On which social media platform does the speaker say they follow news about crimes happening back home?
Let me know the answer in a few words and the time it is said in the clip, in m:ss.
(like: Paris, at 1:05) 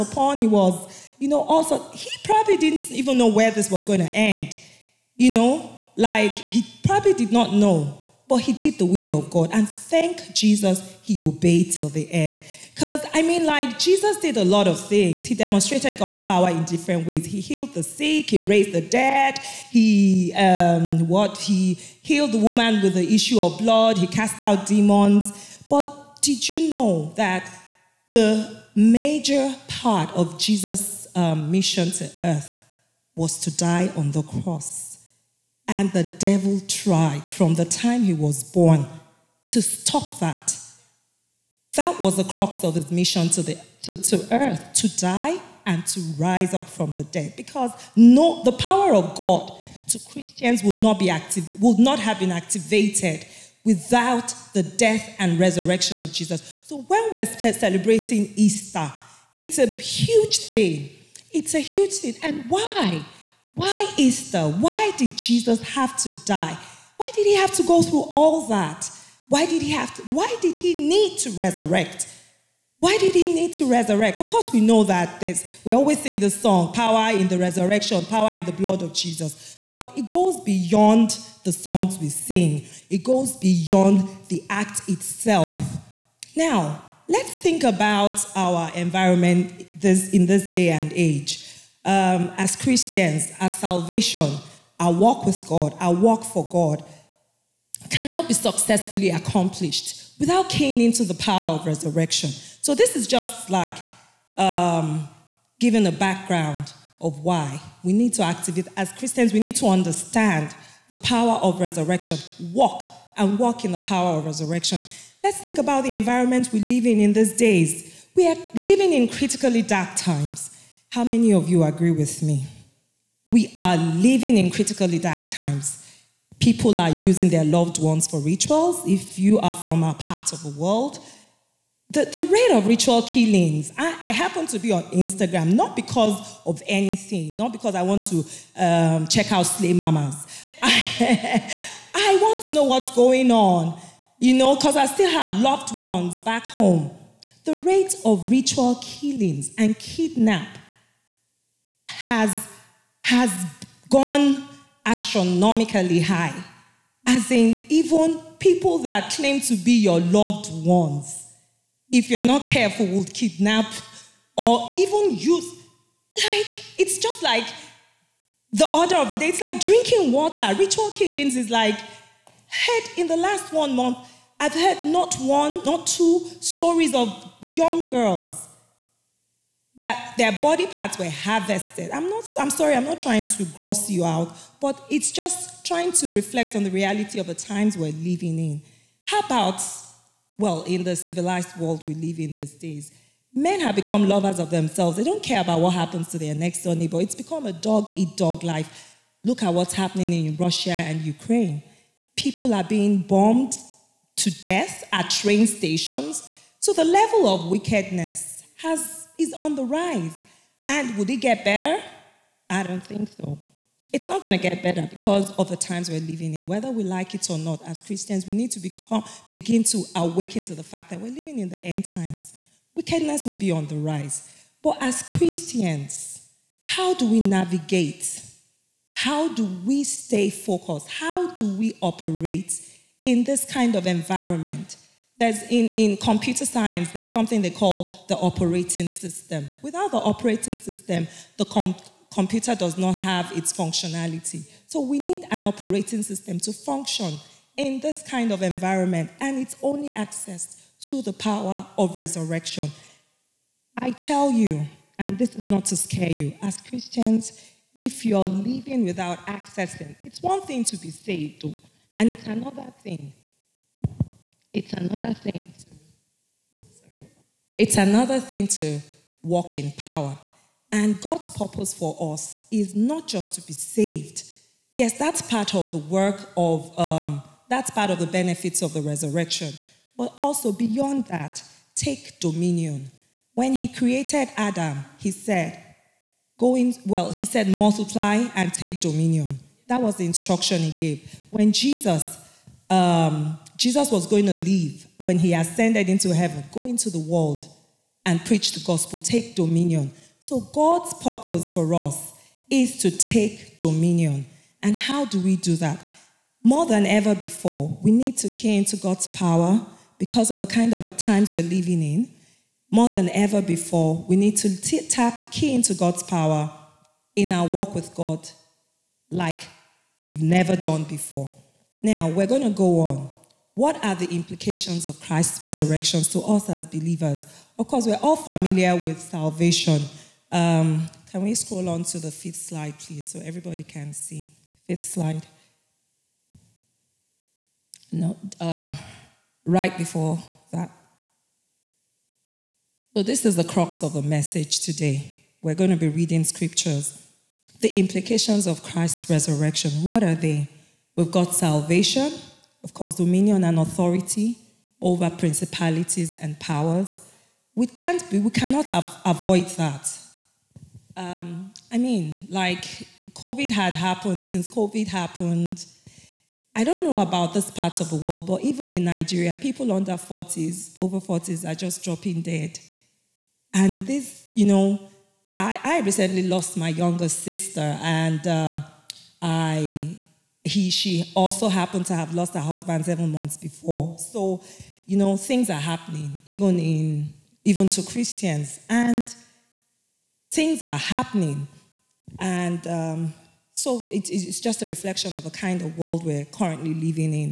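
Instagram, at 2:14.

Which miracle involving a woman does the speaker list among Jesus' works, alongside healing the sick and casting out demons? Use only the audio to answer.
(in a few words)
issue of blood.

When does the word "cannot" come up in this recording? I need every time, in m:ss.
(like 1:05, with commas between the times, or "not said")
1:37, 5:58.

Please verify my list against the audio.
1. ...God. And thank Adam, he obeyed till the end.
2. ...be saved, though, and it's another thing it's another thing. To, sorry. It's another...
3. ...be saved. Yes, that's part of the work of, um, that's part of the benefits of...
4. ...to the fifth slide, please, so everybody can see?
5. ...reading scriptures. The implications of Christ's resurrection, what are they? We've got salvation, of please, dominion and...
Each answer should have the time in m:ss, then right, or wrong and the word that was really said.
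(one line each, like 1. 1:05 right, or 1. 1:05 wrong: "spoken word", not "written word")
1. 0:09 wrong: "Jesus", not "Adam"
2. 4:20 right
3. 4:33 right
4. 5:31 right
5. 5:45 wrong: "course", not "please".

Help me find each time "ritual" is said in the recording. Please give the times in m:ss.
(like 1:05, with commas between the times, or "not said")
2:08, 2:12, 2:28, 2:50.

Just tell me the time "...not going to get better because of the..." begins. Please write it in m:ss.
3:34.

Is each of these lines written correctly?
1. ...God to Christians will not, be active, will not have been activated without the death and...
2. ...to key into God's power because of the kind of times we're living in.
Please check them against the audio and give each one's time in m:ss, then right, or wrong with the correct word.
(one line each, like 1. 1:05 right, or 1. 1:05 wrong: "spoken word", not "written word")
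1. 0:49 right
2. 5:08 right.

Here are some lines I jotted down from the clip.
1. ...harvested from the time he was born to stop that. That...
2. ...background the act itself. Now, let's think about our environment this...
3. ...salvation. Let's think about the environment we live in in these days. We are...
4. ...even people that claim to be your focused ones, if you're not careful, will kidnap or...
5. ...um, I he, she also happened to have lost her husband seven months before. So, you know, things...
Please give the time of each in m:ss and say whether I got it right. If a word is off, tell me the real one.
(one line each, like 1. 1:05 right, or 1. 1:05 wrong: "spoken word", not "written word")
1. 0:36 wrong: "tried", not "harvested"
2. 1:23 wrong: "beyond", not "background"
3. 1:54 wrong: "resurrection", not "salvation"
4. 2:37 wrong: "loved", not "focused"
5. 6:18 right.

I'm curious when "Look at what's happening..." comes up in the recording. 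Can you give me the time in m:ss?
3:19.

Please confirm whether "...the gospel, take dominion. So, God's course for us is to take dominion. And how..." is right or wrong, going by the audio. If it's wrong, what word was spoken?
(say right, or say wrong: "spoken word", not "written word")
wrong: "purpose", not "course".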